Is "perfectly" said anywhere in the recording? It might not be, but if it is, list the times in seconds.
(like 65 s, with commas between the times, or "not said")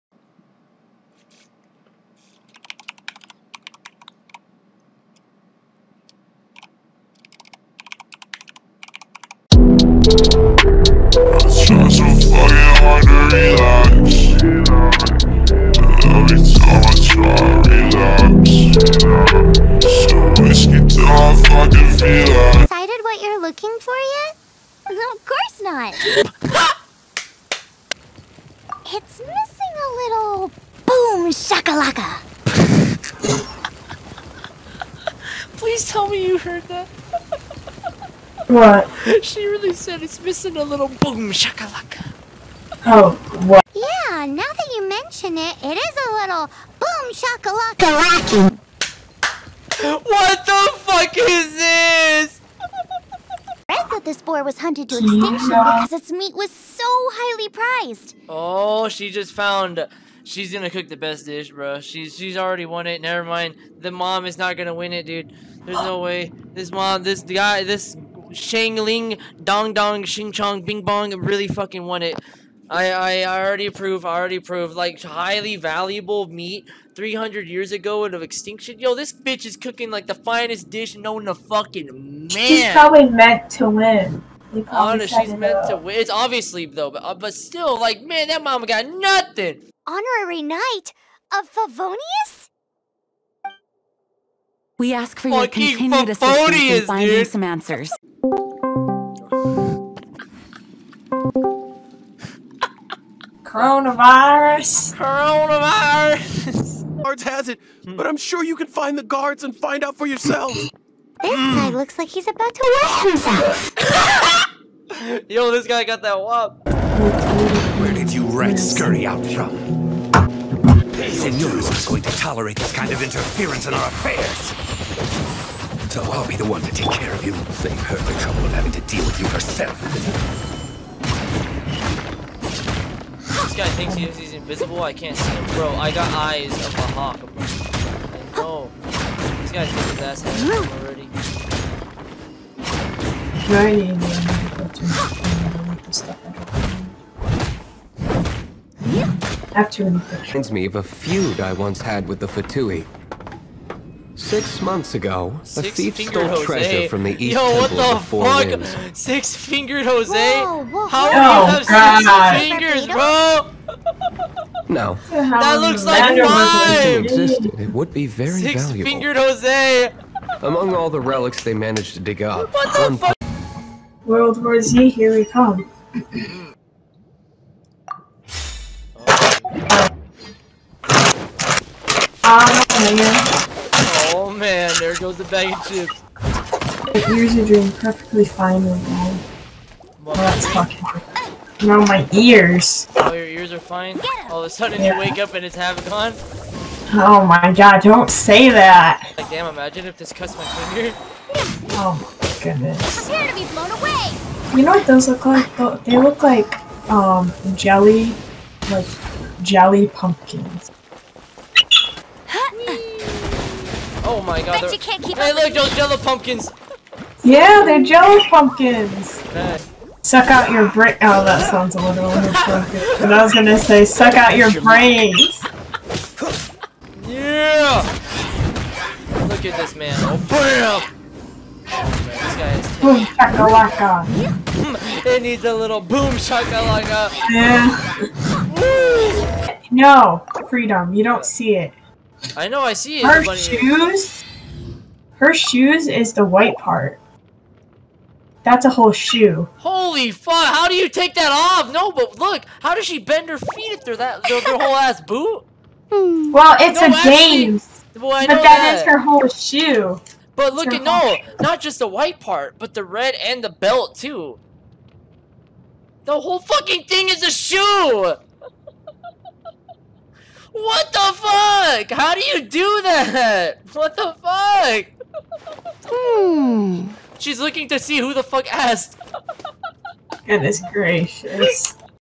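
187 s.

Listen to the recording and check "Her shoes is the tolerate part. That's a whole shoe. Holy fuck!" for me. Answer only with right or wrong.
wrong.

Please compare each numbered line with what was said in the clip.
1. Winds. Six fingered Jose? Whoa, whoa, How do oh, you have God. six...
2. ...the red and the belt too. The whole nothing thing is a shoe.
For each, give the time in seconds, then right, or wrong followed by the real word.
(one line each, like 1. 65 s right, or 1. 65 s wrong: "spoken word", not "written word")
1. 158 s right
2. 262 s wrong: "fucking", not "nothing".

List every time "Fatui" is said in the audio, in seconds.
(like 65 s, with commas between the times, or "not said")
152 s.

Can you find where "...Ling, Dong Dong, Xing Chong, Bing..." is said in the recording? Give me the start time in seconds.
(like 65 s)
68 s.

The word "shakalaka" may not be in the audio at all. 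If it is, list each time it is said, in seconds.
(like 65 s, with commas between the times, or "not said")
41 s, 47 s, 236 s.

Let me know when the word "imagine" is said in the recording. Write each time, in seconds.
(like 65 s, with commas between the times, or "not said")
199 s.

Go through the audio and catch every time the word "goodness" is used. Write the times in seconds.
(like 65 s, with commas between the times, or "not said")
202 s, 280 s.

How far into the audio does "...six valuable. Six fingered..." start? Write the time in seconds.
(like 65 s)
168 s.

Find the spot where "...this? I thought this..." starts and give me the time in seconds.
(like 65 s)
51 s.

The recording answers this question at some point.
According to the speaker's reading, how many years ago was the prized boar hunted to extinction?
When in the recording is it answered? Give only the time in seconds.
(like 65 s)
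76 s.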